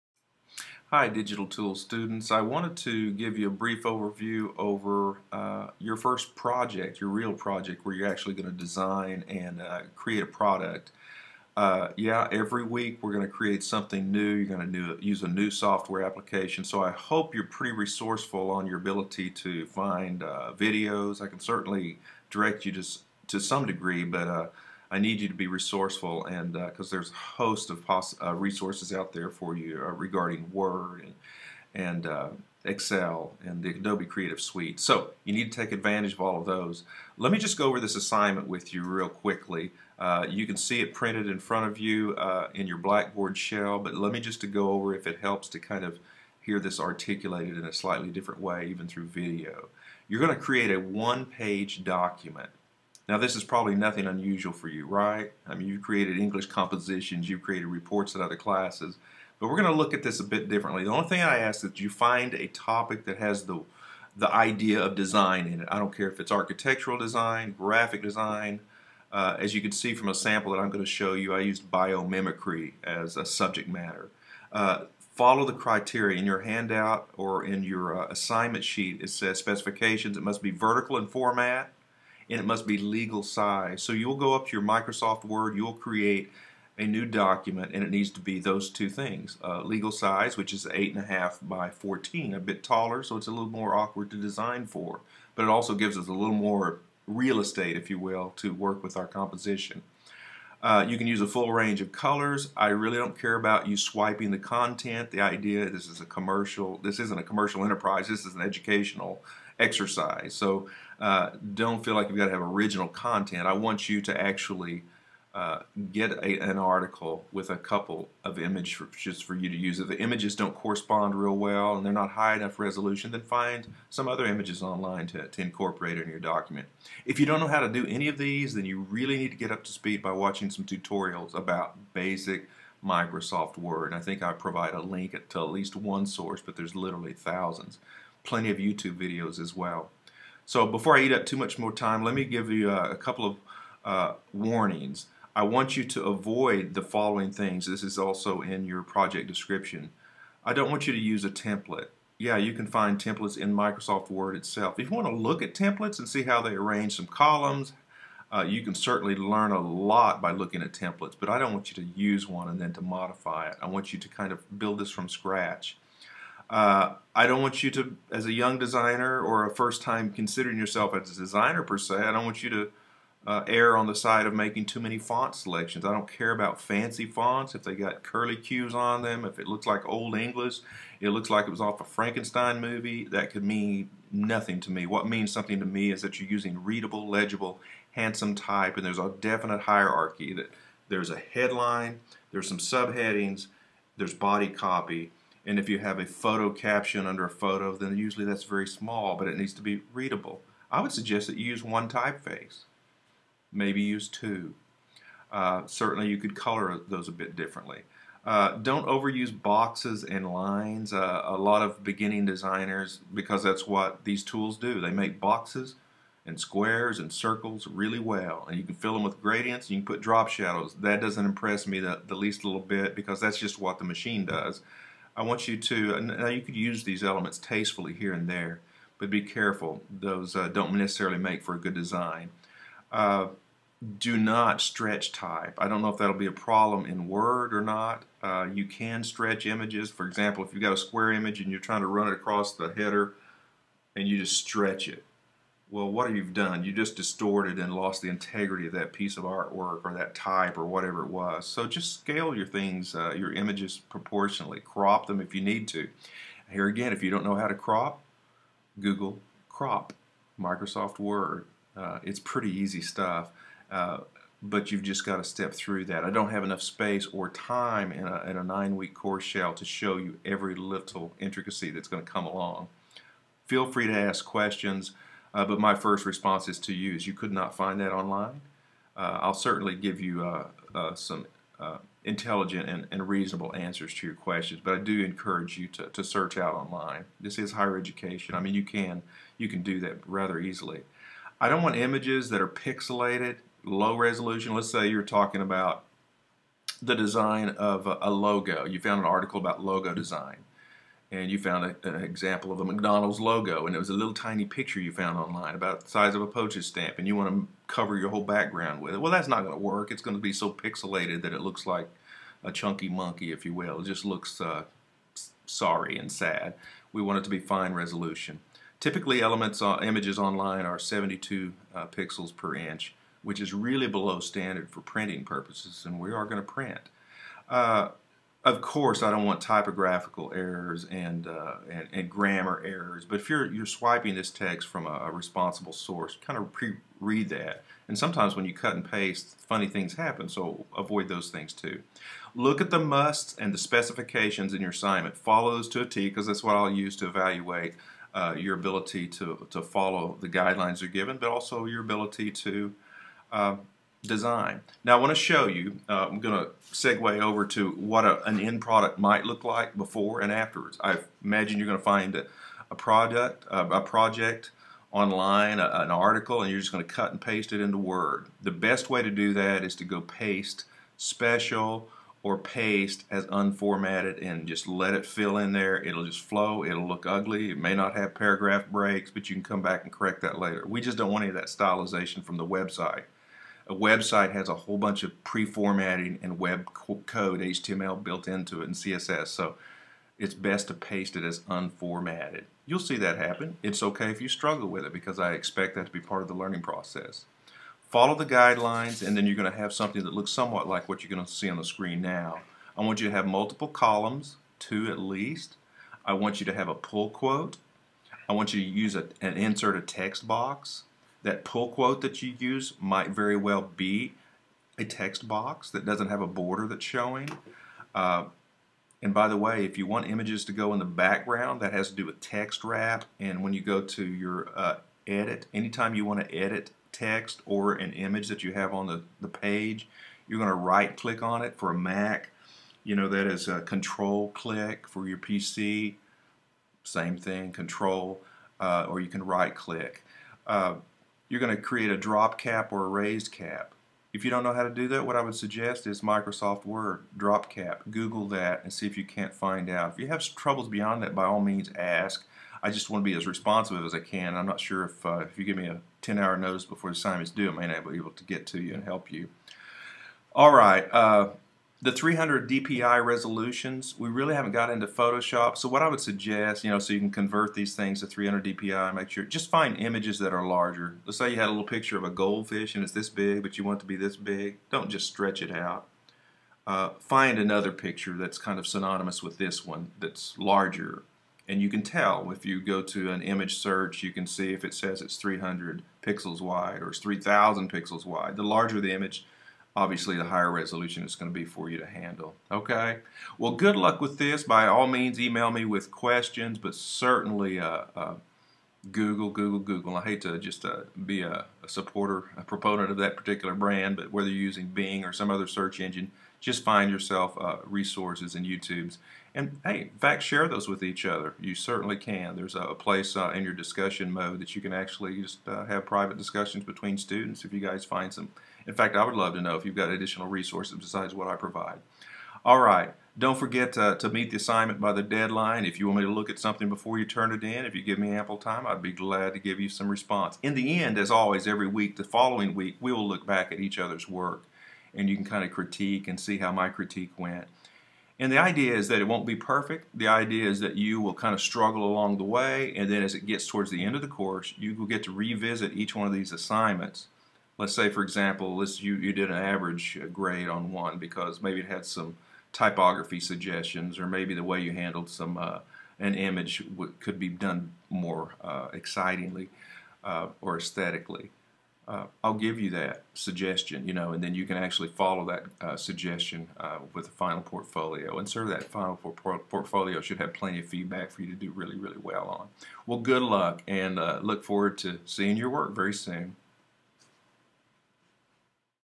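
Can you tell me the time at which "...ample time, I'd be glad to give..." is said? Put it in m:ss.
8:48.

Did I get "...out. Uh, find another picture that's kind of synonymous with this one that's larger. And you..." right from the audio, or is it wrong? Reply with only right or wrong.
right.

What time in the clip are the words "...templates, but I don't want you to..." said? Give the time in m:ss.
2:40.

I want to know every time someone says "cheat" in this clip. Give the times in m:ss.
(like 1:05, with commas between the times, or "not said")
not said.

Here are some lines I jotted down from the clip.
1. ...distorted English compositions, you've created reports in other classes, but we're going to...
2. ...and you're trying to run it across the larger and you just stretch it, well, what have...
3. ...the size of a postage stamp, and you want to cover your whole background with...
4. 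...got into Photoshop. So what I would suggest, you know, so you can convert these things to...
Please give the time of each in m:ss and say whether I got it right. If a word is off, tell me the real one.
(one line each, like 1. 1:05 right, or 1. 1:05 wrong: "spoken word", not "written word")
1. 0:55 wrong: "created", not "distorted"
2. 4:01 wrong: "header", not "larger"
3. 5:05 right
4. 7:44 right.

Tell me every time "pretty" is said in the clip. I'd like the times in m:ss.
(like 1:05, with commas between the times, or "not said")
0:17, 4:22.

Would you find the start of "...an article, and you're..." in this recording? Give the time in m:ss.
6:05.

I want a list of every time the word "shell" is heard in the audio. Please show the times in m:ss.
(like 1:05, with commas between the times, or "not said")
0:43, 4:29.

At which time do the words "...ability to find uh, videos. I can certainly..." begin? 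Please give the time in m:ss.
0:18.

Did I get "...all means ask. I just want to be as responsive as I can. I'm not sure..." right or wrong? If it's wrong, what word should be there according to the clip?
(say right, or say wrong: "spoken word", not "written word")
right.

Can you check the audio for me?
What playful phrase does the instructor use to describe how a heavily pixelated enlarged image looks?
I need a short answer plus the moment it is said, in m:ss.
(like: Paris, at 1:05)
a chunky monkey, at 5:12.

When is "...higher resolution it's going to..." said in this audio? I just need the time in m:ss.
8:10.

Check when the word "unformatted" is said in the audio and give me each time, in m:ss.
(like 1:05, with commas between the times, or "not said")
6:13, 6:31.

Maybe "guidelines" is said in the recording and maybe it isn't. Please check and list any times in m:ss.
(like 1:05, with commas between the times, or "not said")
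5:50, 6:38.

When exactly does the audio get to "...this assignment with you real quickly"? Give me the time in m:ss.
0:37.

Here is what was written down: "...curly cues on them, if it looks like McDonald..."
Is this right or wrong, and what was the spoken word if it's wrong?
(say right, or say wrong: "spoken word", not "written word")
wrong: "Old", not "McDonald".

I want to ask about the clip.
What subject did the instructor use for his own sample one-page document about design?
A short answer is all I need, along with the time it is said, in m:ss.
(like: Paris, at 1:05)
biomimicry, at 1:11.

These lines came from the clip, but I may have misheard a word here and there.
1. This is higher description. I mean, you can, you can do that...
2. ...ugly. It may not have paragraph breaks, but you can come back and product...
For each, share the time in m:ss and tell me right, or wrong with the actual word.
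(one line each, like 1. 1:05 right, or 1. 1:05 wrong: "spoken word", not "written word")
1. 4:47 wrong: "education", not "description"
2. 6:17 wrong: "correct", not "product".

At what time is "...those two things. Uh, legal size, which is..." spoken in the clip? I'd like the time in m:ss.
1:28.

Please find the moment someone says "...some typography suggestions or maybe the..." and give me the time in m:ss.
9:11.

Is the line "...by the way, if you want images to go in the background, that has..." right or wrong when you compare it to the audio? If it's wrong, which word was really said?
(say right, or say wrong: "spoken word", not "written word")
right.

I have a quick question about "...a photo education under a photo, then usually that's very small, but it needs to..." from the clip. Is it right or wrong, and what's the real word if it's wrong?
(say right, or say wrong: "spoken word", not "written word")
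wrong: "caption", not "education".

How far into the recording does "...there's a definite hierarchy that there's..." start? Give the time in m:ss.
3:08.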